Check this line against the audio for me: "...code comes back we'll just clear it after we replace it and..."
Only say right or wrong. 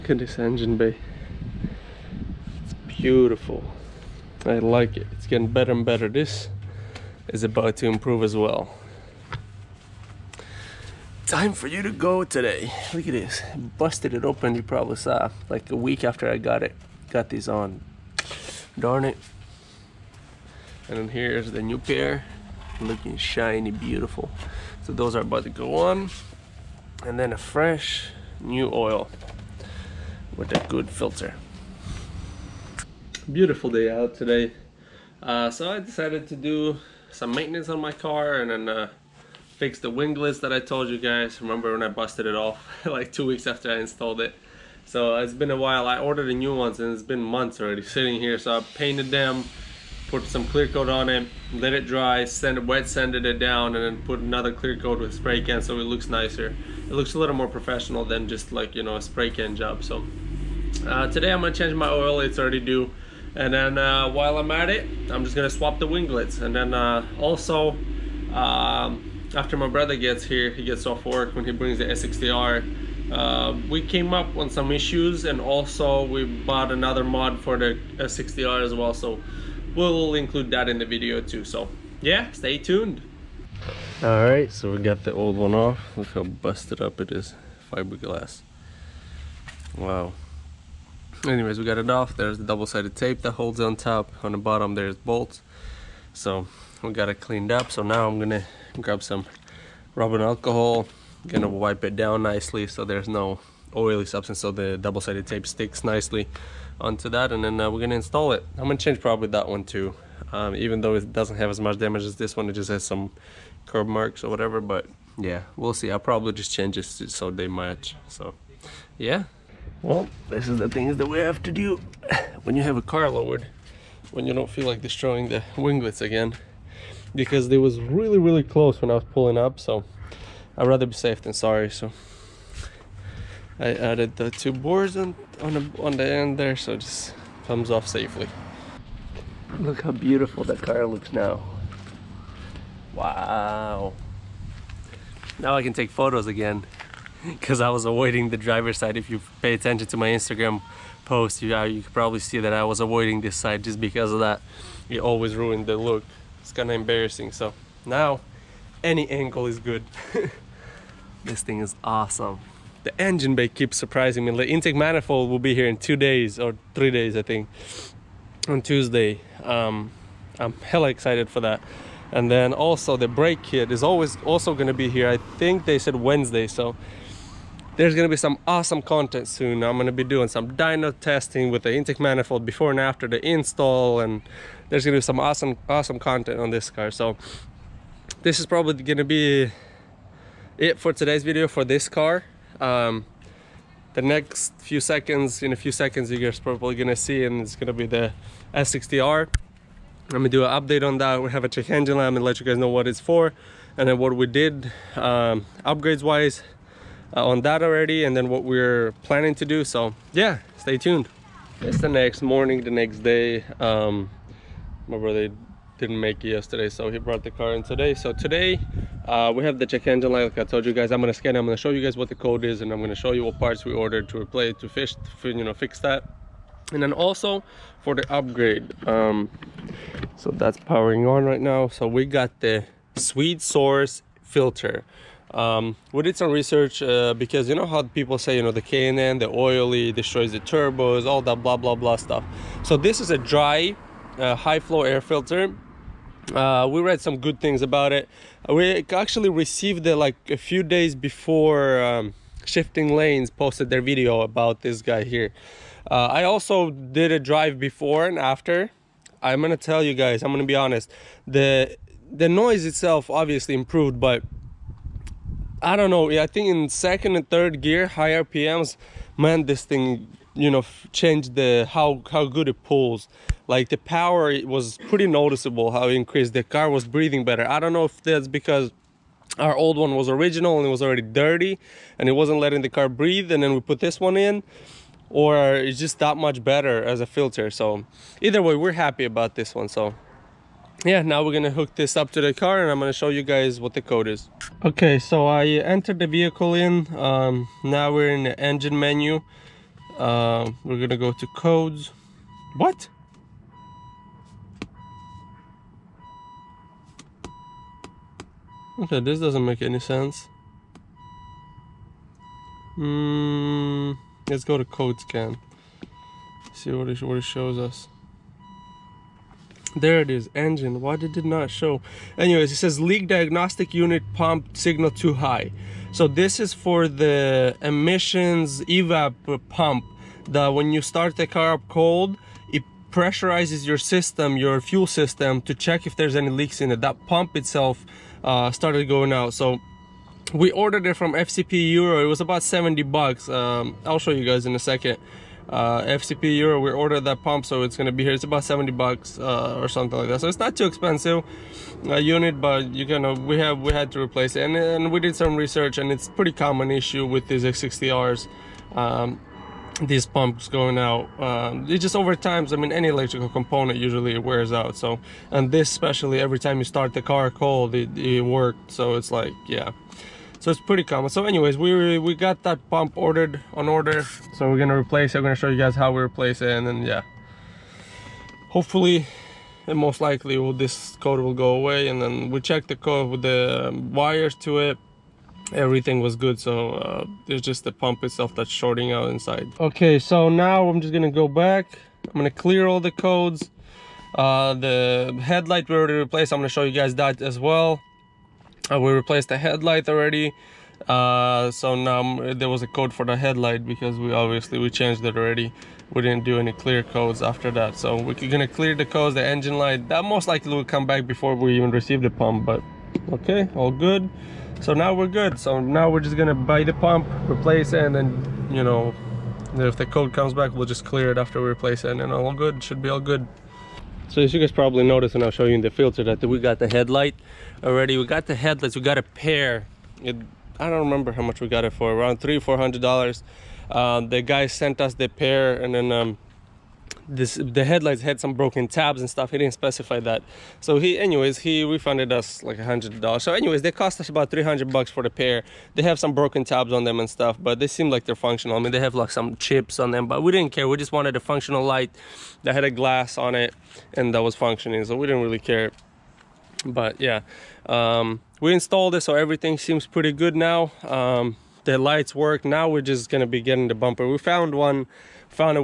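right.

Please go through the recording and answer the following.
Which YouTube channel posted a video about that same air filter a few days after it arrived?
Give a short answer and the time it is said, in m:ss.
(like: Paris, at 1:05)
Shifting Lanes, at 4:12.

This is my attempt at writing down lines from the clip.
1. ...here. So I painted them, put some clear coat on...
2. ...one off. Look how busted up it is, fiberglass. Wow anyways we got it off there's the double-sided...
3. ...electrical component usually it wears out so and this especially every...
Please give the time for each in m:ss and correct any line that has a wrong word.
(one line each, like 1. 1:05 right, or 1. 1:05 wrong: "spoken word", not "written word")
1. 0:48 right
2. 1:25 right
3. 6:02 right.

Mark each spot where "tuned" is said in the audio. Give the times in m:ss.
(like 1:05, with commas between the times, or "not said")
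1:22, 3:30.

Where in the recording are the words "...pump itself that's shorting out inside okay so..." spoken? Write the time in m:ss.
6:27.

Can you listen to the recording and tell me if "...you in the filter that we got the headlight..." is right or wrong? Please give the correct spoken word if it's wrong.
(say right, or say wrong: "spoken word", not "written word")
right.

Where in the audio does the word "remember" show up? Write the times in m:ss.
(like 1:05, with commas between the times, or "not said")
0:41, 7:10.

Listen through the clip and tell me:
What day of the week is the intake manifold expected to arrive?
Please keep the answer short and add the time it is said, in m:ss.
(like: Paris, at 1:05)
Tuesday, at 2:48.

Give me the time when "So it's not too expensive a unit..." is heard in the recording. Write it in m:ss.
5:50.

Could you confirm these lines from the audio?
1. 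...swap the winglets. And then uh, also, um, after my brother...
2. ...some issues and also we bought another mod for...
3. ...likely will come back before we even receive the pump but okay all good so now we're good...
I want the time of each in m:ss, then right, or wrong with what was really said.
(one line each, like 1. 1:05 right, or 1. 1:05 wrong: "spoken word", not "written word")
1. 1:05 right
2. 1:14 right
3. 6:50 right.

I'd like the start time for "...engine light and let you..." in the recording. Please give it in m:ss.
3:21.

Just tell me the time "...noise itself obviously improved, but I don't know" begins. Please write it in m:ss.
4:22.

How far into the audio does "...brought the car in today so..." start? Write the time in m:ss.
3:36.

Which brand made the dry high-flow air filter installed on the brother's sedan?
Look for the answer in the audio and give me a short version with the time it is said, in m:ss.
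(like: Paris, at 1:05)
Swede Source, at 3:52.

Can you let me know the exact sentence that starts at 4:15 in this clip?
Uh, I also did a drive before and after.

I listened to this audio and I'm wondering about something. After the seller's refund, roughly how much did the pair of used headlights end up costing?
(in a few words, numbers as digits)
$300.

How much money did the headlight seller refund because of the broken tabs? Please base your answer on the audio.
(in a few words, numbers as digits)
$100.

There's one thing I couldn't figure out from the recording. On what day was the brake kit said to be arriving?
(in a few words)
Wednesday.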